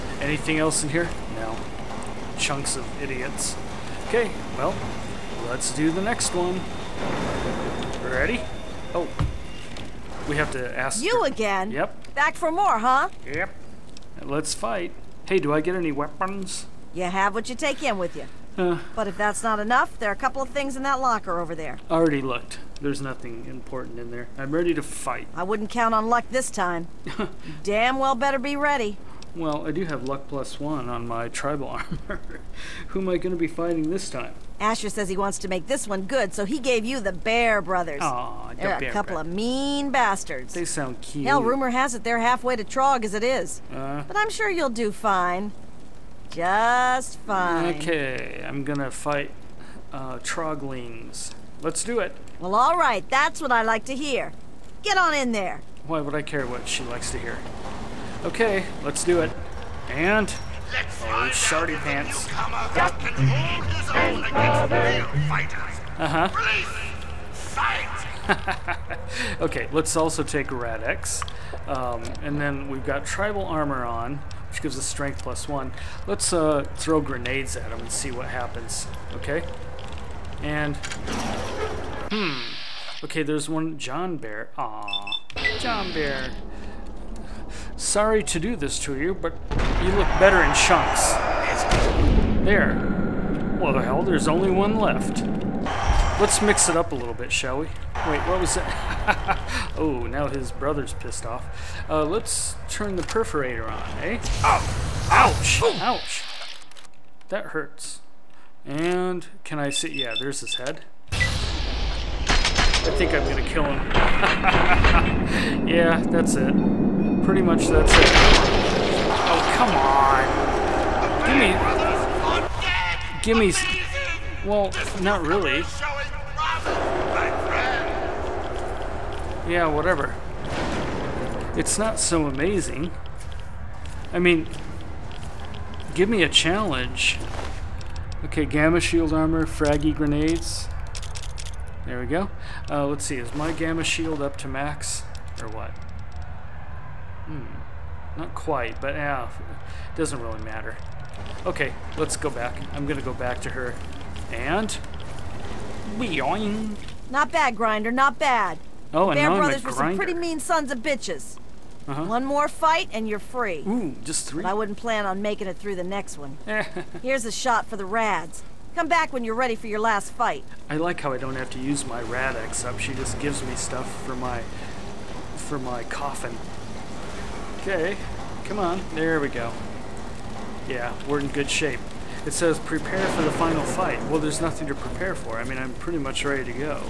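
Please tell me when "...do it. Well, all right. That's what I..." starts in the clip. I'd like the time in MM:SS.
00:51.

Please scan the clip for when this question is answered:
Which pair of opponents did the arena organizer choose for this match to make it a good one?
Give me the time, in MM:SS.
00:36.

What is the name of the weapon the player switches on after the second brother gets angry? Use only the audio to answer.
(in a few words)
Perforator.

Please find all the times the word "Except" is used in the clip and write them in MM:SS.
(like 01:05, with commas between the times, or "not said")
02:52.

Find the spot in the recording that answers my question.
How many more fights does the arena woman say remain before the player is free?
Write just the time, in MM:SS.
02:42.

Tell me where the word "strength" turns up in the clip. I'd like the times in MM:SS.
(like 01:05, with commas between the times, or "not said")
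01:14.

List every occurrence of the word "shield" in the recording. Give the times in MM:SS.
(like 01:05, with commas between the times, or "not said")
02:18, 02:23.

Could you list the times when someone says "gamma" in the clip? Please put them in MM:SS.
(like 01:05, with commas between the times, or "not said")
02:18, 02:23.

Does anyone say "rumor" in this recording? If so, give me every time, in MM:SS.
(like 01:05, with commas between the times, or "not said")
00:41.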